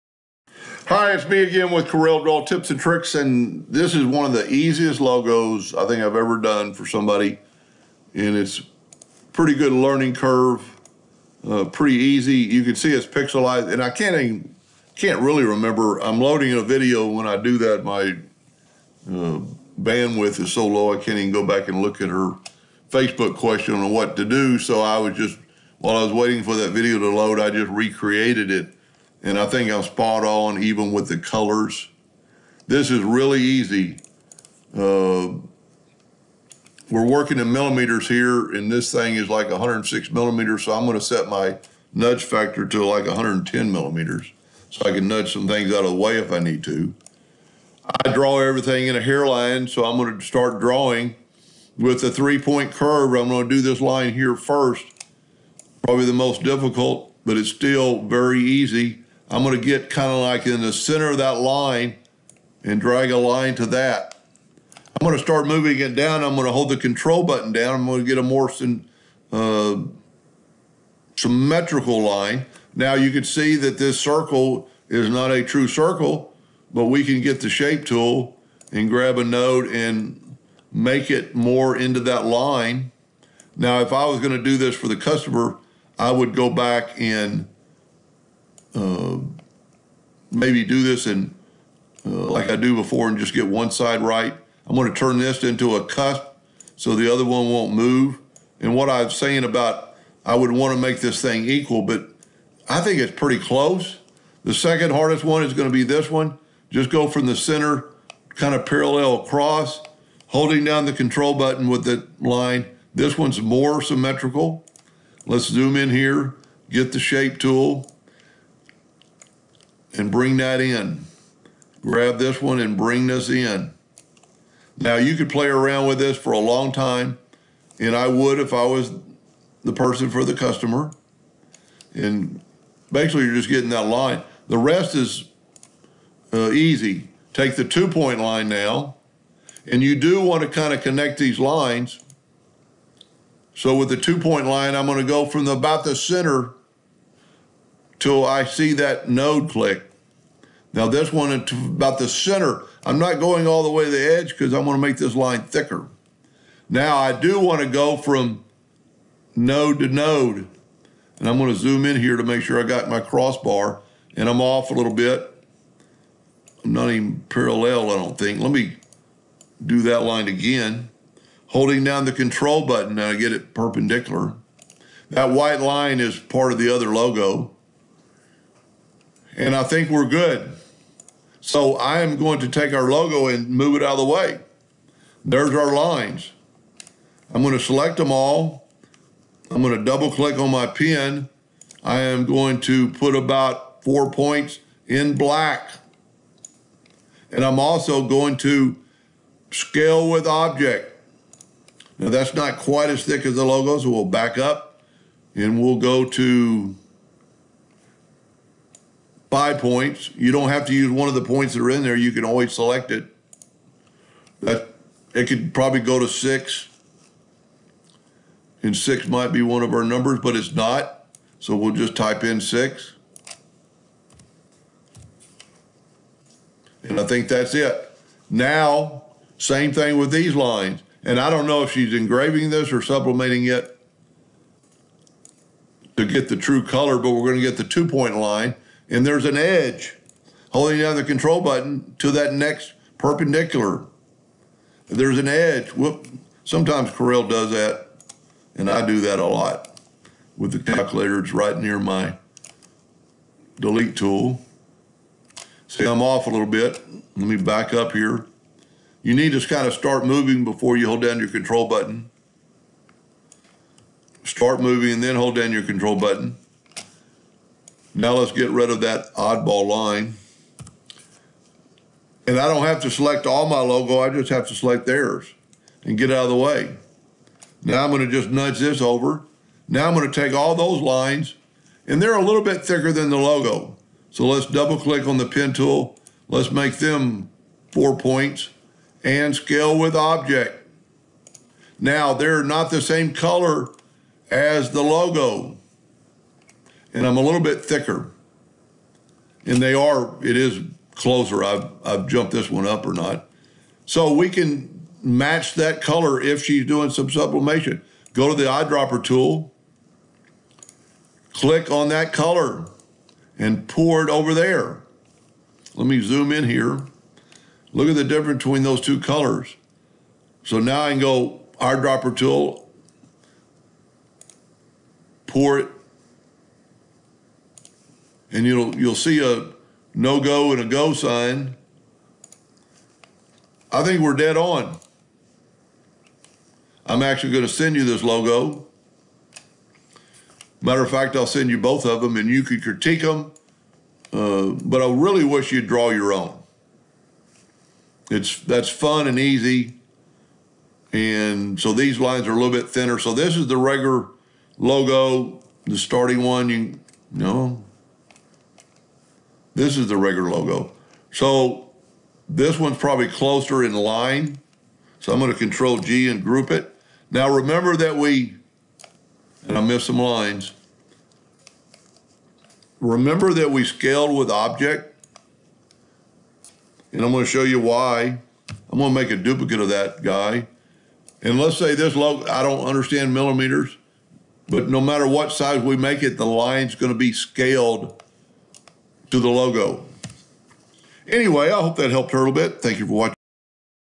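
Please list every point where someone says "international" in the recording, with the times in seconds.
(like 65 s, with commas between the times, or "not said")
not said.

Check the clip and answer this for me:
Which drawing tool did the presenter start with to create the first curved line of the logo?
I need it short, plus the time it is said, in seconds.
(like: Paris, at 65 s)
three-point curve, at 52 s.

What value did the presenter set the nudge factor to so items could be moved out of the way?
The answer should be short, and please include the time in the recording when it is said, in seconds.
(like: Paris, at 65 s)
110 millimeters, at 43 s.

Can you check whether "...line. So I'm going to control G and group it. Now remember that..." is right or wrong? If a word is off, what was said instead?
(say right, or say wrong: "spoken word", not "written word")
right.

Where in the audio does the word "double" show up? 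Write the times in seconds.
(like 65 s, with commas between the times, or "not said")
189 s, 284 s.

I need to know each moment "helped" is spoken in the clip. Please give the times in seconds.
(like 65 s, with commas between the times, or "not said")
391 s.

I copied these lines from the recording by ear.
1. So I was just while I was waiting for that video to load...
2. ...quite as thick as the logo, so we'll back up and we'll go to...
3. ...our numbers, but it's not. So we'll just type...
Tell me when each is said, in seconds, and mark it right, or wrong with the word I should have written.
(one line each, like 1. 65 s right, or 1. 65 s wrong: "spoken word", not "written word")
1. 24 s right
2. 202 s right
3. 219 s right.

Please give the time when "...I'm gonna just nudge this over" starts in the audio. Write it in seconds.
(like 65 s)
277 s.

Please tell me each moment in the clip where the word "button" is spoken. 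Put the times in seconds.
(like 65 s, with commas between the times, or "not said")
67 s, 111 s, 172 s, 241 s, 261 s, 265 s.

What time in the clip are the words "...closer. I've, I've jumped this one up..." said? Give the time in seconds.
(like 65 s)
300 s.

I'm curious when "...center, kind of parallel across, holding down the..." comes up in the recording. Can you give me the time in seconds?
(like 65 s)
107 s.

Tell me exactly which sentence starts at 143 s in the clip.
So, with the two point line, I'm going to go from the, about the center till I see that node click.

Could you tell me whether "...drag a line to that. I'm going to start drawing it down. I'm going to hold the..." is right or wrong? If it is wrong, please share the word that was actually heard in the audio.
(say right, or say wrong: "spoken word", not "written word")
wrong: "moving", not "drawing".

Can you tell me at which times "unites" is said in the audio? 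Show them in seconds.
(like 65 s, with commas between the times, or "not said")
not said.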